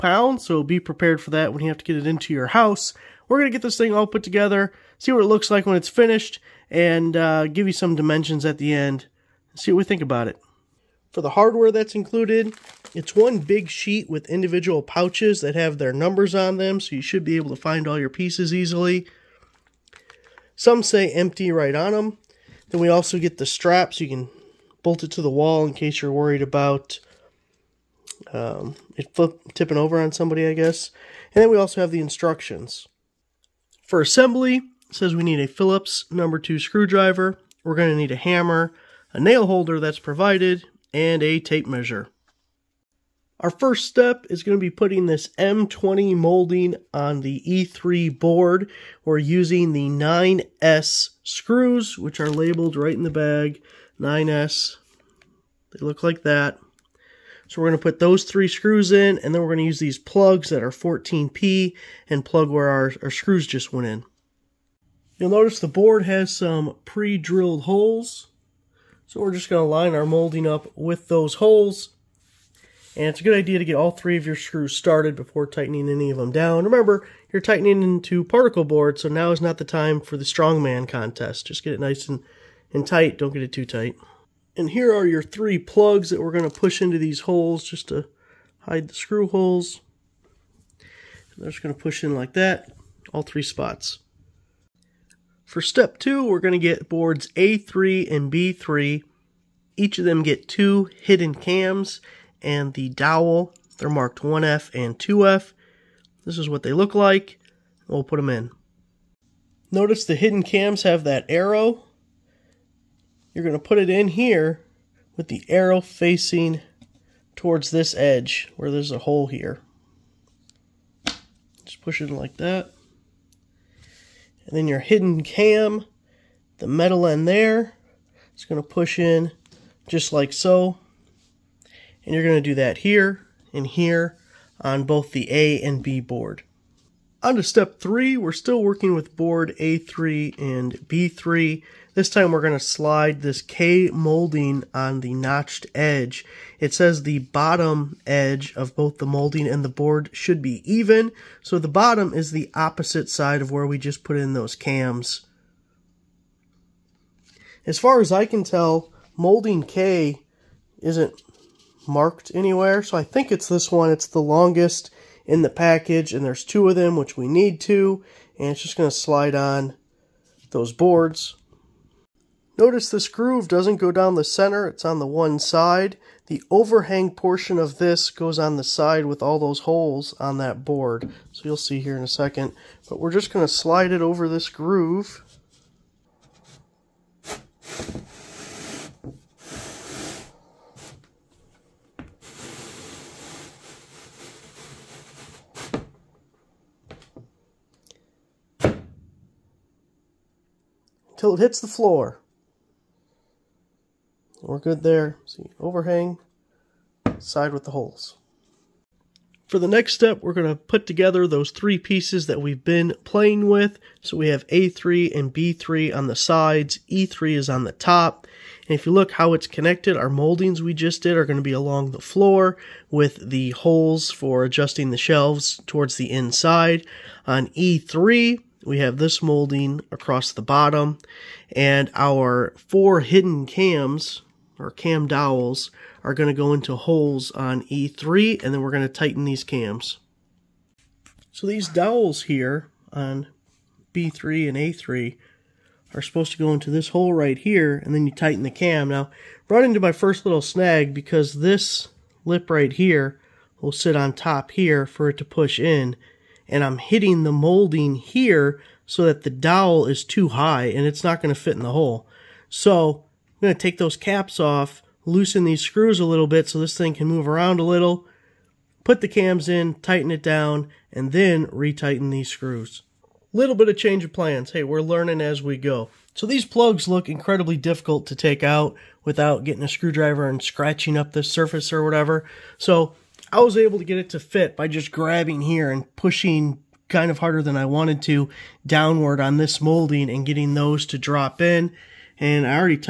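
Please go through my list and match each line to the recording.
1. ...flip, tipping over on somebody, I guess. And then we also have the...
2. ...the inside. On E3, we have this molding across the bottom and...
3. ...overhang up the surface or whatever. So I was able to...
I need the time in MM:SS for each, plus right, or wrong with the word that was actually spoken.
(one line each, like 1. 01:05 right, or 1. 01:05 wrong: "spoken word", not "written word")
1. 00:29 right
2. 03:45 right
3. 04:40 wrong: "scratching", not "overhang".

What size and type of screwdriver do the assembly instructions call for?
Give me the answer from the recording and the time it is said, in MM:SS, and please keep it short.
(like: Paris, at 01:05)
Phillips number 2, at 00:35.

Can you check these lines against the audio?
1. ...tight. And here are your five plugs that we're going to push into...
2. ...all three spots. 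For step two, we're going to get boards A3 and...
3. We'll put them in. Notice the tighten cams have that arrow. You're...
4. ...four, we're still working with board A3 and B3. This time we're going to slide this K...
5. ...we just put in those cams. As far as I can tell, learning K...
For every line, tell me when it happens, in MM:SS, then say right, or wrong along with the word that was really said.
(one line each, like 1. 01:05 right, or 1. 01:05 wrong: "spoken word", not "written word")
1. 01:23 wrong: "three", not "five"
2. 01:33 right
3. 01:47 wrong: "hidden", not "tighten"
4. 02:17 wrong: "three", not "four"
5. 02:33 wrong: "molding", not "learning".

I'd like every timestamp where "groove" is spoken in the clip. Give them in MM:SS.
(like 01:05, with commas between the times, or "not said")
02:53, 03:04.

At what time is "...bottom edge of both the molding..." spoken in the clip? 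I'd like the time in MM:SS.
02:27.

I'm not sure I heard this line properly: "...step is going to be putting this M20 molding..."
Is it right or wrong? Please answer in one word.
right.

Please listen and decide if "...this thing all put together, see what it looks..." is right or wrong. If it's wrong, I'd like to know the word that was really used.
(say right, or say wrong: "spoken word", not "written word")
right.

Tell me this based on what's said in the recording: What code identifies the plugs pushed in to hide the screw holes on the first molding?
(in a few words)
14P.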